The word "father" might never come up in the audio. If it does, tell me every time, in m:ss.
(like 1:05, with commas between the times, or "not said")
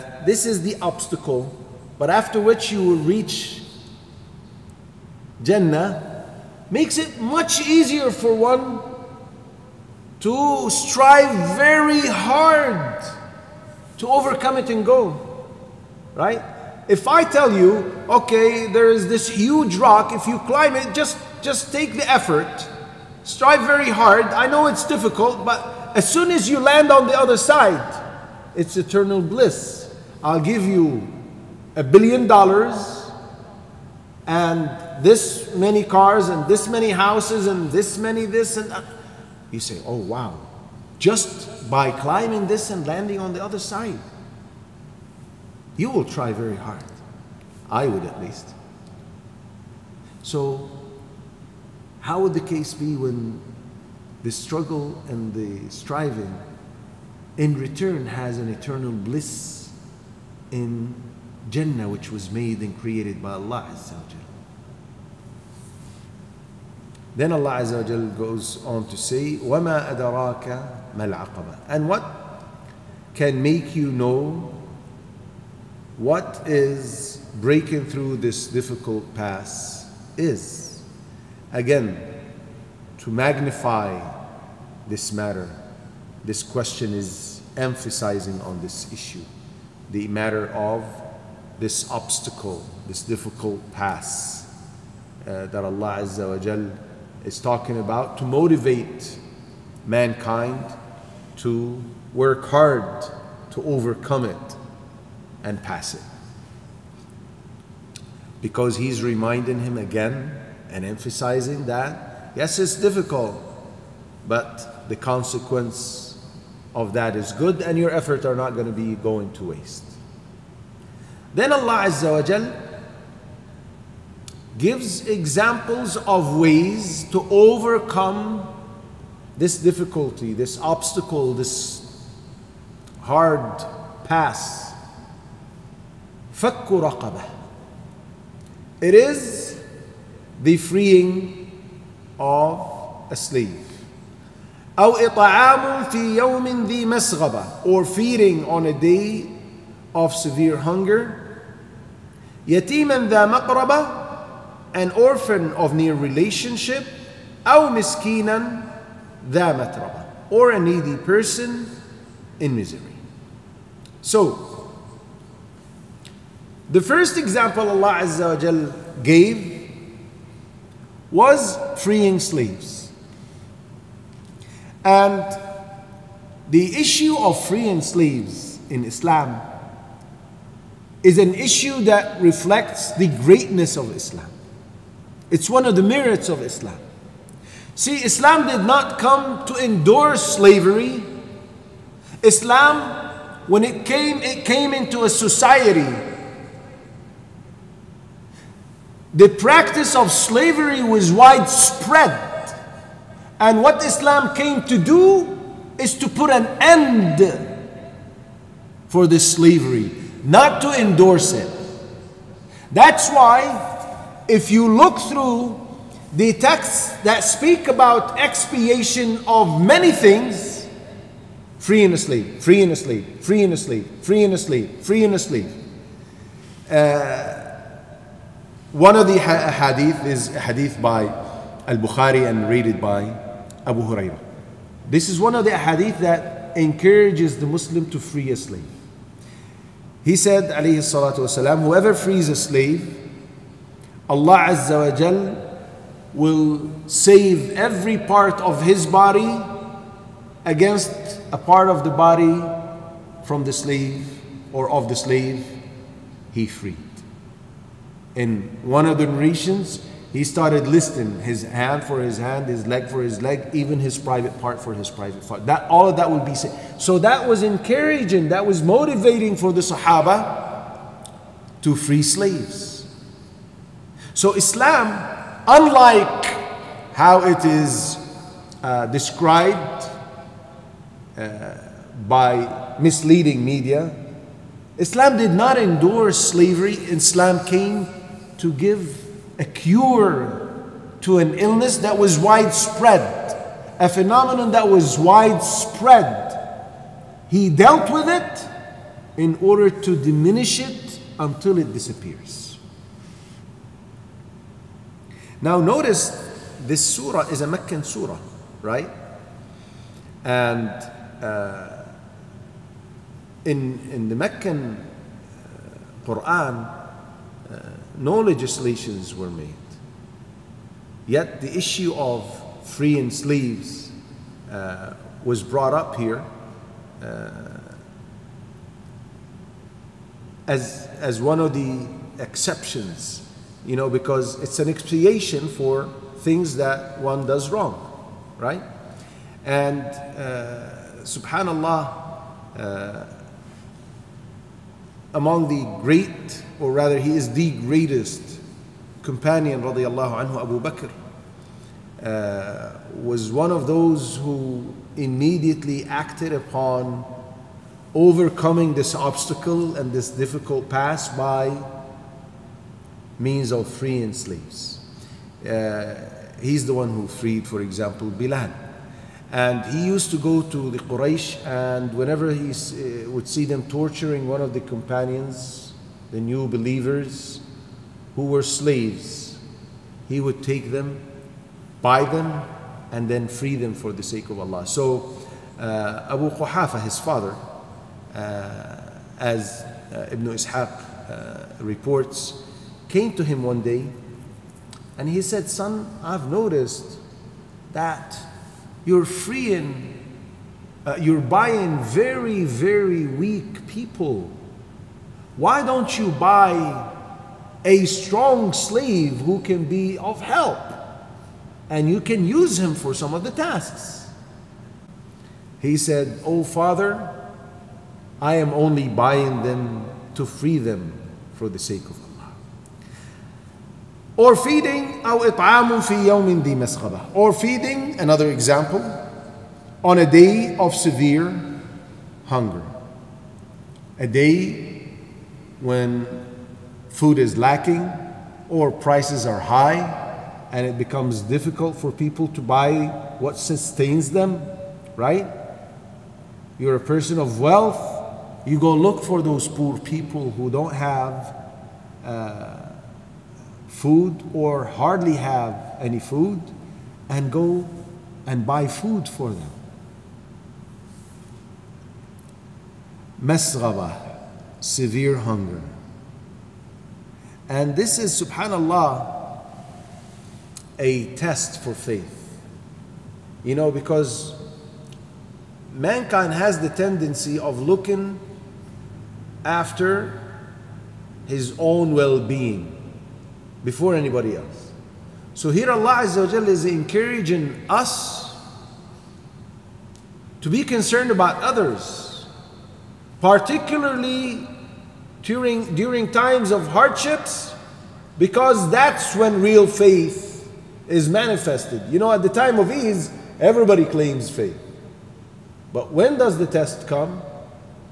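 6:26, 6:56.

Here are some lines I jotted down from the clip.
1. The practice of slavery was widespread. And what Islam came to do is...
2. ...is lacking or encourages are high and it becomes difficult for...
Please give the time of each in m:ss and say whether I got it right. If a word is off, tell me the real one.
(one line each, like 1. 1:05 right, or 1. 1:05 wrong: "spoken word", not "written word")
1. 3:19 right
2. 7:17 wrong: "prices", not "encourages".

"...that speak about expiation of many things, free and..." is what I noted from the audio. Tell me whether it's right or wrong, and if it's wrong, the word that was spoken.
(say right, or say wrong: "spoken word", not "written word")
right.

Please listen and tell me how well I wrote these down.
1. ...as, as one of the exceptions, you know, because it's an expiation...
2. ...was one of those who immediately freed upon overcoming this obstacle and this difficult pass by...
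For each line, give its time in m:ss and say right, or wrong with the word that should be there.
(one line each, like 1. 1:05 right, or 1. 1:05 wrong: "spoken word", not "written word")
1. 5:30 right
2. 5:53 wrong: "acted", not "freed".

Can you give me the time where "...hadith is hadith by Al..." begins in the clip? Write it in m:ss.
3:49.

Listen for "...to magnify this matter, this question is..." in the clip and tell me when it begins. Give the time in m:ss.
1:22.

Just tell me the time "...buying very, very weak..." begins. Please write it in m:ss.
6:41.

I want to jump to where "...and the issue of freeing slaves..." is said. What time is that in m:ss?
2:54.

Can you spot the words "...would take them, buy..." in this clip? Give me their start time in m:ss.
6:20.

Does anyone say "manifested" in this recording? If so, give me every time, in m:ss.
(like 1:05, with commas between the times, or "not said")
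8:21.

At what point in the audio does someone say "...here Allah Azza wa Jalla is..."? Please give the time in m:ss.
8:05.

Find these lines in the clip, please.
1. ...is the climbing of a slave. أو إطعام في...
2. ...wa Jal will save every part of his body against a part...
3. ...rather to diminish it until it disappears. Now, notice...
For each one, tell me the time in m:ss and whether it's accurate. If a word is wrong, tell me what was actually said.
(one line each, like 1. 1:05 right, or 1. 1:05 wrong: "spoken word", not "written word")
1. 2:18 wrong: "freeing", not "climbing"
2. 4:04 right
3. 4:59 wrong: "order", not "rather".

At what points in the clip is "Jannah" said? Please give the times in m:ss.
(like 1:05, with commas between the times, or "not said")
0:05, 1:01.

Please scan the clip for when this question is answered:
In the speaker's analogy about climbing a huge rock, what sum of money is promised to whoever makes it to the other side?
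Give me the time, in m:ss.
0:31.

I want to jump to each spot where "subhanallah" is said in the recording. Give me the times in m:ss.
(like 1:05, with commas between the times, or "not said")
5:41, 7:48.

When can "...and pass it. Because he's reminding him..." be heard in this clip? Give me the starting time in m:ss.
1:45.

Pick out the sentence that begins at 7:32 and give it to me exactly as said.
Uh, food or hardly have any food and go and buy food for them.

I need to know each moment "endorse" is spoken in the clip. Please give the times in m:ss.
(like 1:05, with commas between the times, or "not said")
3:09, 3:30, 4:45.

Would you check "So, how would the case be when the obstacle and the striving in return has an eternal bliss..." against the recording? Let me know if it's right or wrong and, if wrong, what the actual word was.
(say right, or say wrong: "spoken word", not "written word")
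wrong: "struggle", not "obstacle".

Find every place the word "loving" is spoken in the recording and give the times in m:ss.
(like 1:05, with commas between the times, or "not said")
not said.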